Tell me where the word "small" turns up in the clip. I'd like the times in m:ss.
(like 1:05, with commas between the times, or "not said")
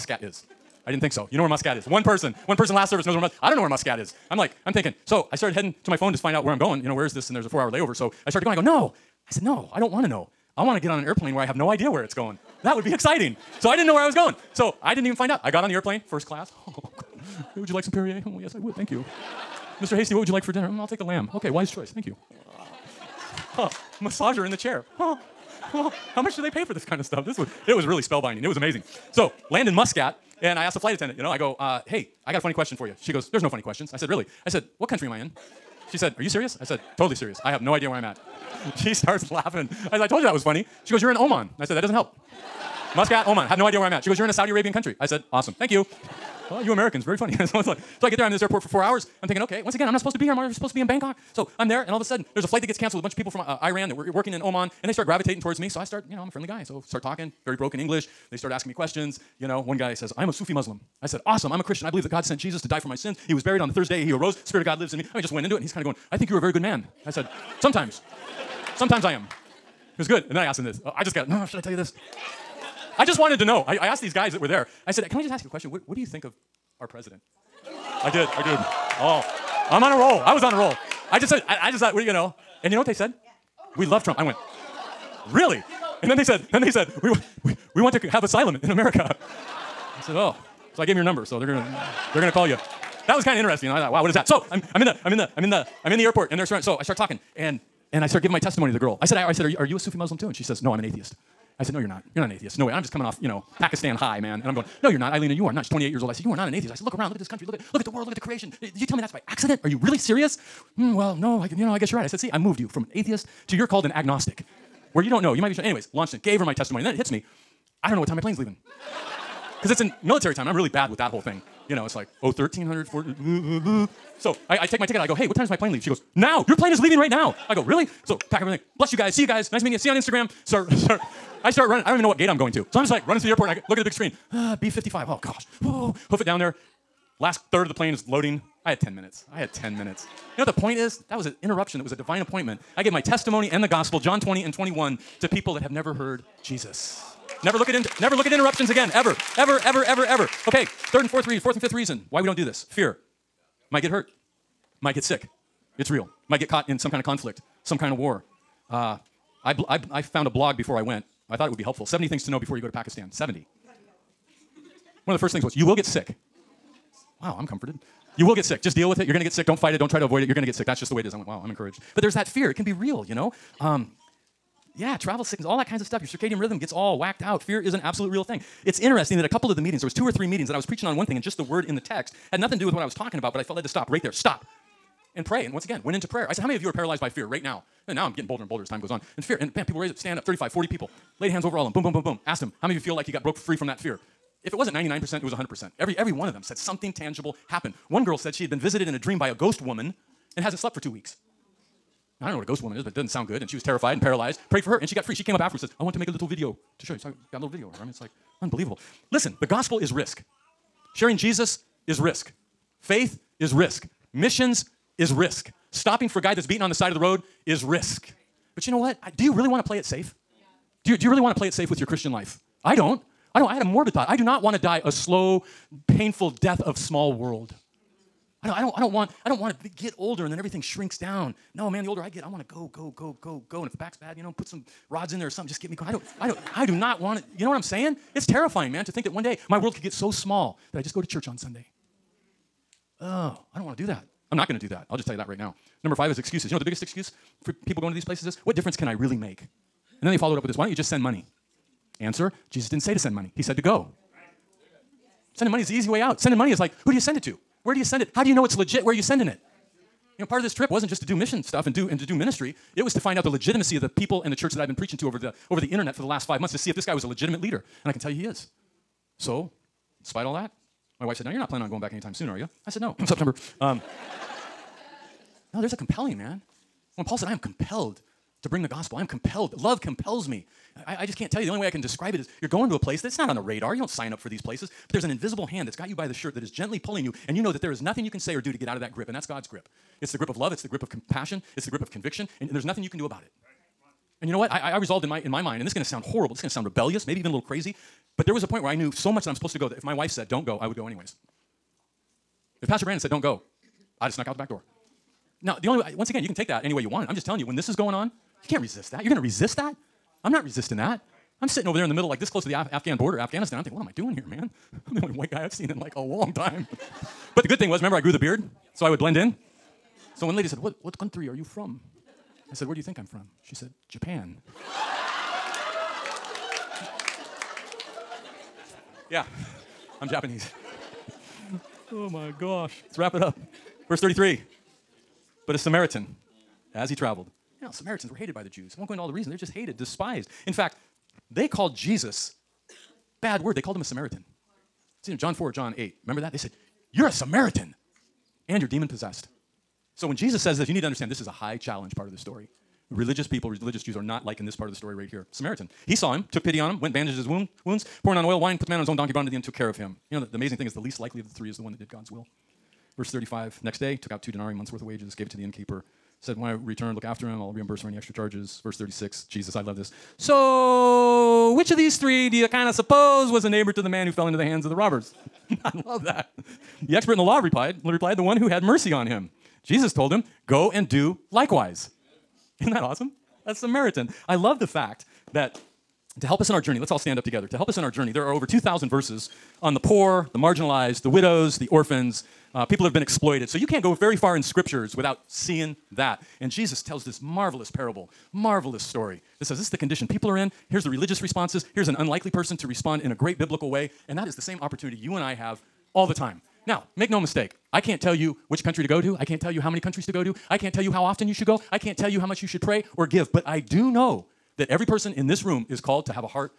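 3:46, 4:00.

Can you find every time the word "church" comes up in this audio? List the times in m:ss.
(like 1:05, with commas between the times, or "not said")
4:01, 4:24.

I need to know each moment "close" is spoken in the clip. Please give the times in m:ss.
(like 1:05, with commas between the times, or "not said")
5:12.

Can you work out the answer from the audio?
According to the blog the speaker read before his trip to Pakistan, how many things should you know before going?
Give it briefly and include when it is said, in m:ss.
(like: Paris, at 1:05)
70, at 2:41.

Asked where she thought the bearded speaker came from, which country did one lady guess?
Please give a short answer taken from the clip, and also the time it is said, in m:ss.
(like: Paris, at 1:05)
Japan, at 5:23.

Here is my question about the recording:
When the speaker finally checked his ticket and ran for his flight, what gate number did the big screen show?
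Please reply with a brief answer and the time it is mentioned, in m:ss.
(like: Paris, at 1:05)
B55, at 2:14.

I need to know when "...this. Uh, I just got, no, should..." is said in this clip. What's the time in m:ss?
1:10.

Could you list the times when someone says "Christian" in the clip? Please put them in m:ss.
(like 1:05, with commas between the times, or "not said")
1:01, 3:41.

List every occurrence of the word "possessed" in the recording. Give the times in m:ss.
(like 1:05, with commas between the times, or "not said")
5:48.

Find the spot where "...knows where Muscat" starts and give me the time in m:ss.
0:03.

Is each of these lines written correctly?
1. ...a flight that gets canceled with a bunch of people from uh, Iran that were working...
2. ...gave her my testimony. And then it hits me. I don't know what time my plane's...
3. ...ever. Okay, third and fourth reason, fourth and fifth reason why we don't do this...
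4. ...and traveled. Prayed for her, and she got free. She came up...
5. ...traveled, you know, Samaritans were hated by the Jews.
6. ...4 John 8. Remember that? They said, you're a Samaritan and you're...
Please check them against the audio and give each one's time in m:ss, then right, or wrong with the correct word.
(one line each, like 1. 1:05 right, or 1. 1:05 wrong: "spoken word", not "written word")
1. 0:52 right
2. 1:56 right
3. 2:30 right
4. 3:23 wrong: "paralyzed", not "traveled"
5. 5:36 right
6. 5:45 right.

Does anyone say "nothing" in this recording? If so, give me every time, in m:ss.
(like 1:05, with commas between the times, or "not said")
3:02, 4:47, 4:52.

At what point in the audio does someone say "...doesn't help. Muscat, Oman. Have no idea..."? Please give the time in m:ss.
0:41.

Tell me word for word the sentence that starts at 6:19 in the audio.
Jesus told him, Go and do likewise.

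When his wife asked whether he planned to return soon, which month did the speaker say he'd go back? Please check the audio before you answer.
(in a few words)
September.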